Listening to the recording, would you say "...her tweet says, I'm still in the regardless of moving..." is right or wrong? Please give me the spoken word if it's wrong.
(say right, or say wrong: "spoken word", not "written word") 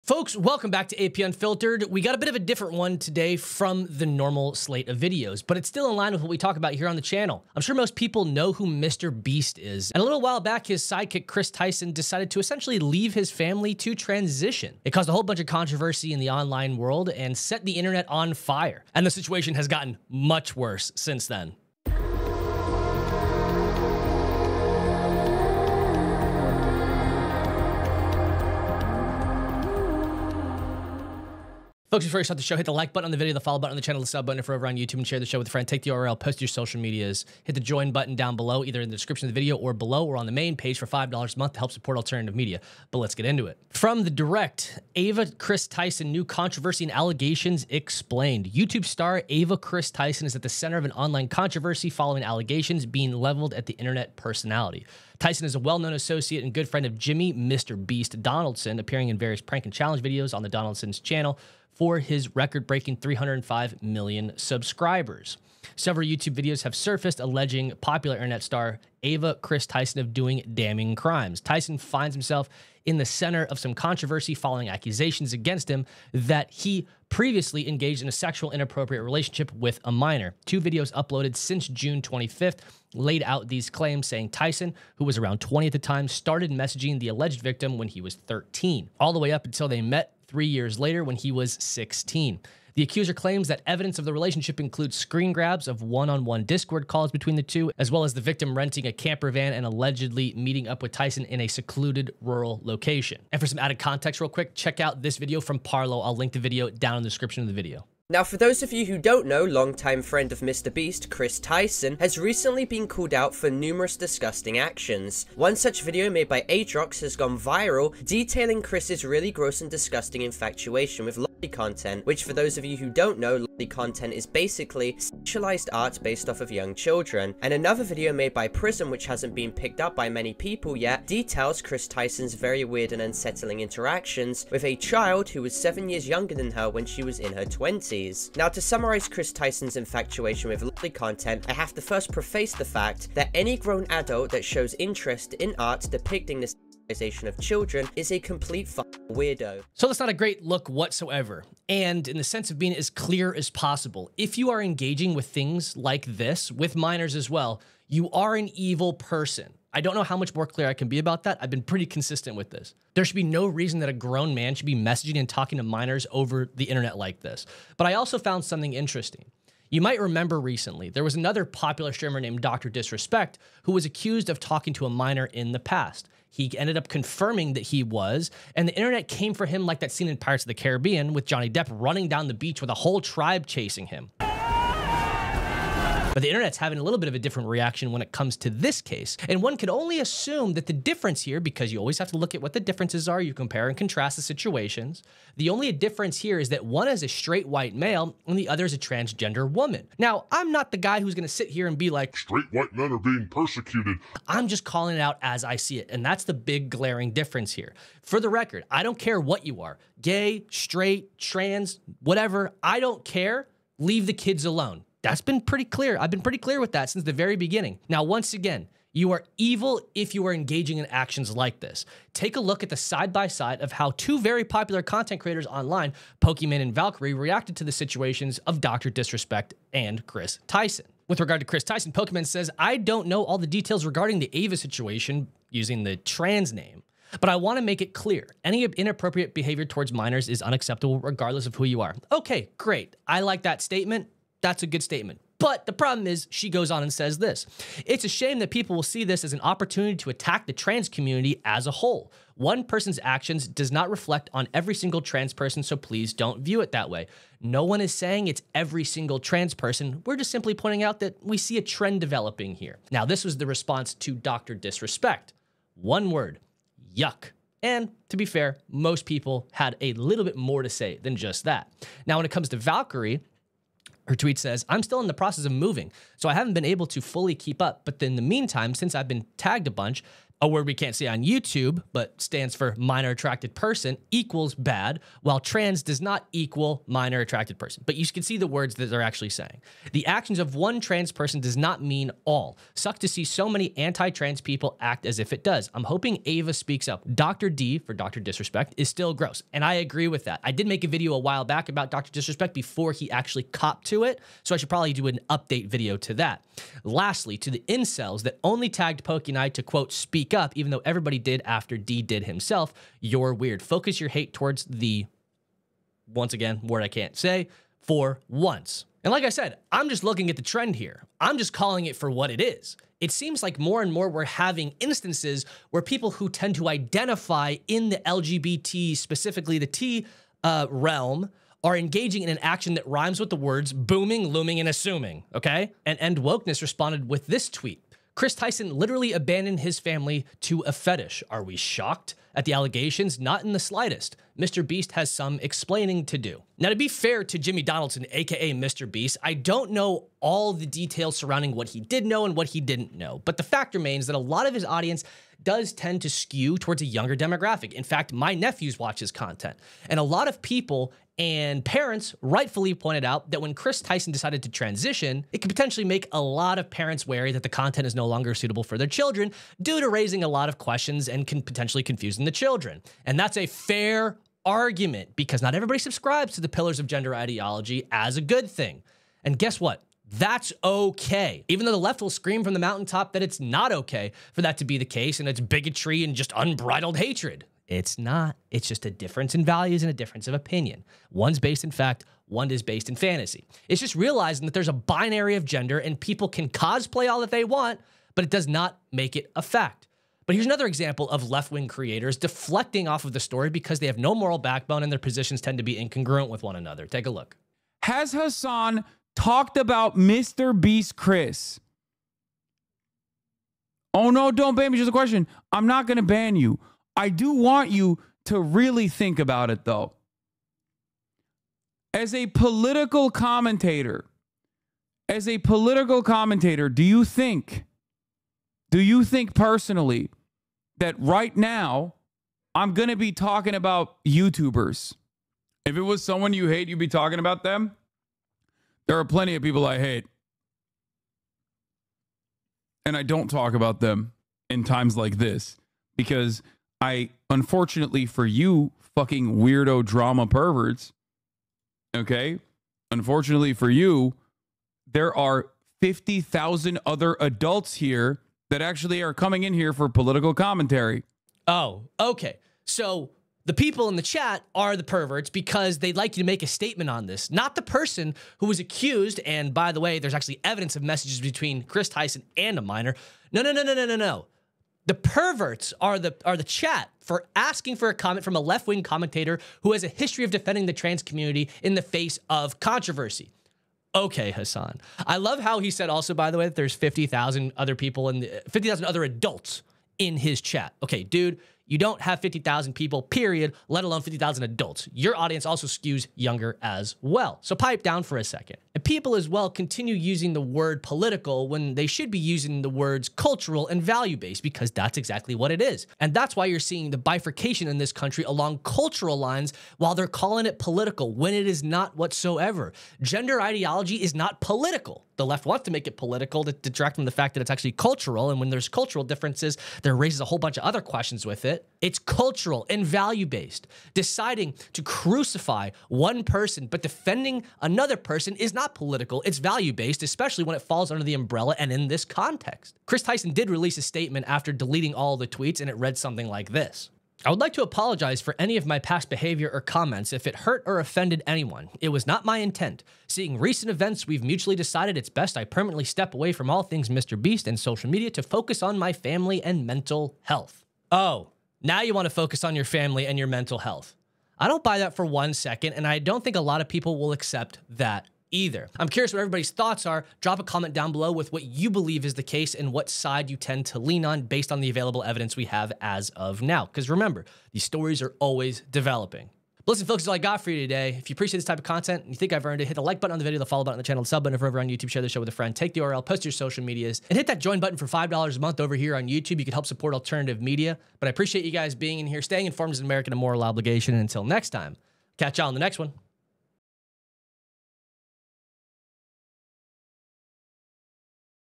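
wrong: "process", not "regardless".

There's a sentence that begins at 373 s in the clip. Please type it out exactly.
And that's a fair argument because not everybody subscribes to the pillars of gender ideology as a good thing.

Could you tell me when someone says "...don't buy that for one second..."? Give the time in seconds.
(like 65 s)
554 s.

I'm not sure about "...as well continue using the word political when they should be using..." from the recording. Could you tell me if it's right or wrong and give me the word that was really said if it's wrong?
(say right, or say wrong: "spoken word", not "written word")
right.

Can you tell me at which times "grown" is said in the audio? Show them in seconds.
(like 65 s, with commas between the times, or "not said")
143 s, 163 s.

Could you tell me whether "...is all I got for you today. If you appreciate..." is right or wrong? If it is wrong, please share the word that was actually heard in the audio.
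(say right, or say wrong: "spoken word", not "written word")
right.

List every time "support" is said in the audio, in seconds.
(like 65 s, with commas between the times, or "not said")
41 s, 579 s.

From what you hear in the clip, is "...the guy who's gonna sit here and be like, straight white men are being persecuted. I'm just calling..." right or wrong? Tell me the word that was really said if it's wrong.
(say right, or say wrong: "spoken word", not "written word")
right.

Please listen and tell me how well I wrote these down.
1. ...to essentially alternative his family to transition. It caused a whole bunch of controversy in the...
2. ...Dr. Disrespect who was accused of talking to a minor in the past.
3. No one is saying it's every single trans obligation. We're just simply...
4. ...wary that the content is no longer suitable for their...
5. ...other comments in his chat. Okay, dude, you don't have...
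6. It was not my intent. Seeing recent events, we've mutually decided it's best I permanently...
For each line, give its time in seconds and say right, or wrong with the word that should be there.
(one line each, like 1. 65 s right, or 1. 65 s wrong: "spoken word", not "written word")
1. 12 s wrong: "leave", not "alternative"
2. 172 s right
3. 257 s wrong: "person", not "obligation"
4. 367 s right
5. 488 s wrong: "adults", not "comments"
6. 541 s right.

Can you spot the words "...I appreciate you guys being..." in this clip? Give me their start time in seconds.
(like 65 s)
581 s.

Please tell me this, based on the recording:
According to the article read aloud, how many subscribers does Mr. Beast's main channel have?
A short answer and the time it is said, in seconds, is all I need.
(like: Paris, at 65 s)
305 million, at 62 s.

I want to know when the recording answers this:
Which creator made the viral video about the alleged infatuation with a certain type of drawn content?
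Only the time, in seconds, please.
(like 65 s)
116 s.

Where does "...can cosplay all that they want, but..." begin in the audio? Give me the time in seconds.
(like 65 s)
396 s.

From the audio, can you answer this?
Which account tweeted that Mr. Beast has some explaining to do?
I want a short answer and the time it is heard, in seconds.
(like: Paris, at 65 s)
End Wokeness, at 335 s.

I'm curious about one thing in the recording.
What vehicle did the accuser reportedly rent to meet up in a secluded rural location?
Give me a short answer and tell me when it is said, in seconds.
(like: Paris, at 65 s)
Camper van, at 98 s.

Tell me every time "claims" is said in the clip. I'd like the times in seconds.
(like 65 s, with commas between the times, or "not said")
83 s, 93 s.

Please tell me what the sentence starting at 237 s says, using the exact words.
But I want to make it clear any inappropriate behavior towards minors is unacceptable, regardless of who you are.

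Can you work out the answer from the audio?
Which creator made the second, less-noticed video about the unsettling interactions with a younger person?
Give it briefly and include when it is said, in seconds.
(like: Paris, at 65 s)
Prism, at 128 s.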